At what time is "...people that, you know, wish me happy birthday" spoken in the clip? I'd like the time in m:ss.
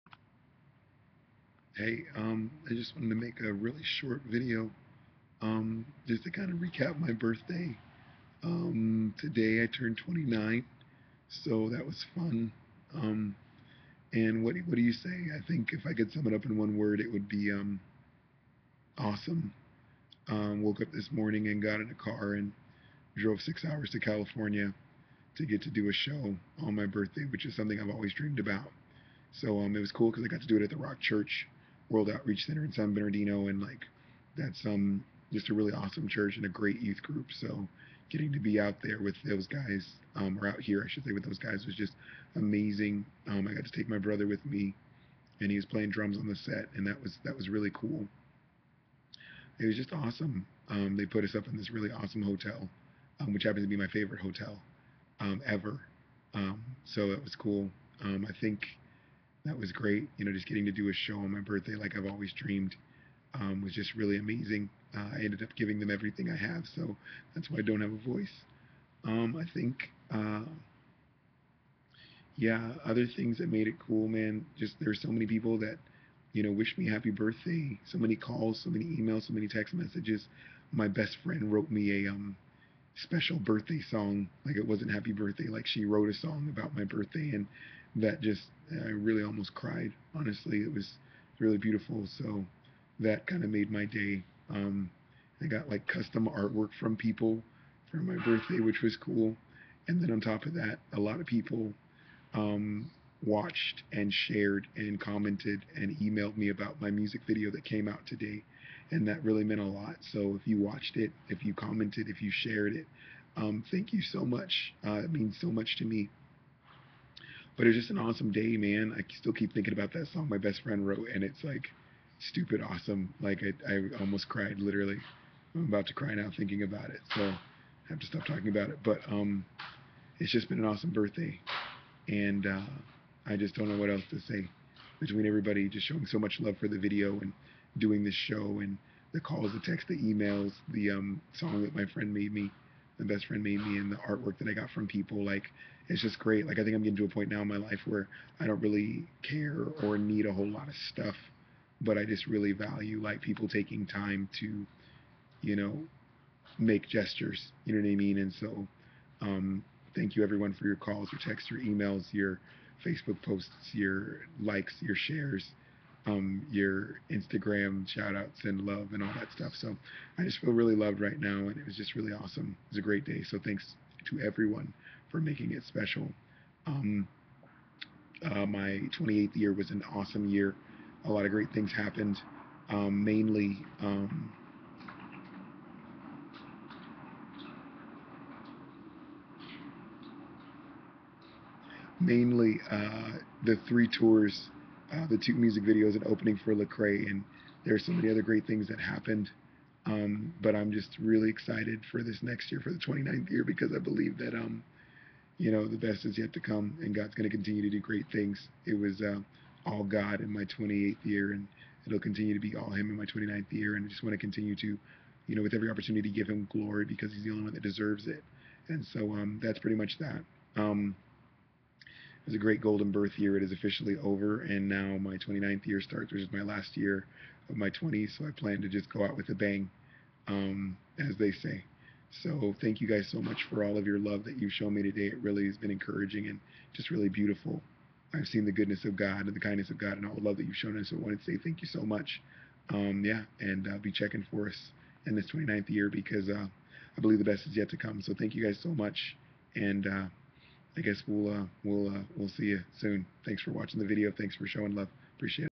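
1:15.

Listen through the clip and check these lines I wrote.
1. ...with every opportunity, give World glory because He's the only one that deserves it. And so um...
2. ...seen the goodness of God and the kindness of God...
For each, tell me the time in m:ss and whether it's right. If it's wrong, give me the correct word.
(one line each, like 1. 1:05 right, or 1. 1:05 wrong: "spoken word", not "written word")
1. 3:35 wrong: "Him", not "World"
2. 3:58 right.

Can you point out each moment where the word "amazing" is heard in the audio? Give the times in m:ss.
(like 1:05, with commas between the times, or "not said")
0:42, 1:04.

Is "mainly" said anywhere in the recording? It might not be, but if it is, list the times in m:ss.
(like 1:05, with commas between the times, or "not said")
3:03, 3:11.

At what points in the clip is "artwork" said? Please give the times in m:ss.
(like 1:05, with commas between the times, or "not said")
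1:36, 2:23.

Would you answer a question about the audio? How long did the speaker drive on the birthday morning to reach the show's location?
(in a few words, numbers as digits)
6 hours.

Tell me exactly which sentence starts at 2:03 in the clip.
Like I, I almost cried literally.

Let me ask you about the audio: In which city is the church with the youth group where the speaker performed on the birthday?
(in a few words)
San Bernardino.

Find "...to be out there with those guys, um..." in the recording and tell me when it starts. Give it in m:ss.
0:38.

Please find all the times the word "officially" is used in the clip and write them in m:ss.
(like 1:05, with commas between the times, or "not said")
3:43.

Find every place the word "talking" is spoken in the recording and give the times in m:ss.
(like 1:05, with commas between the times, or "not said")
2:08.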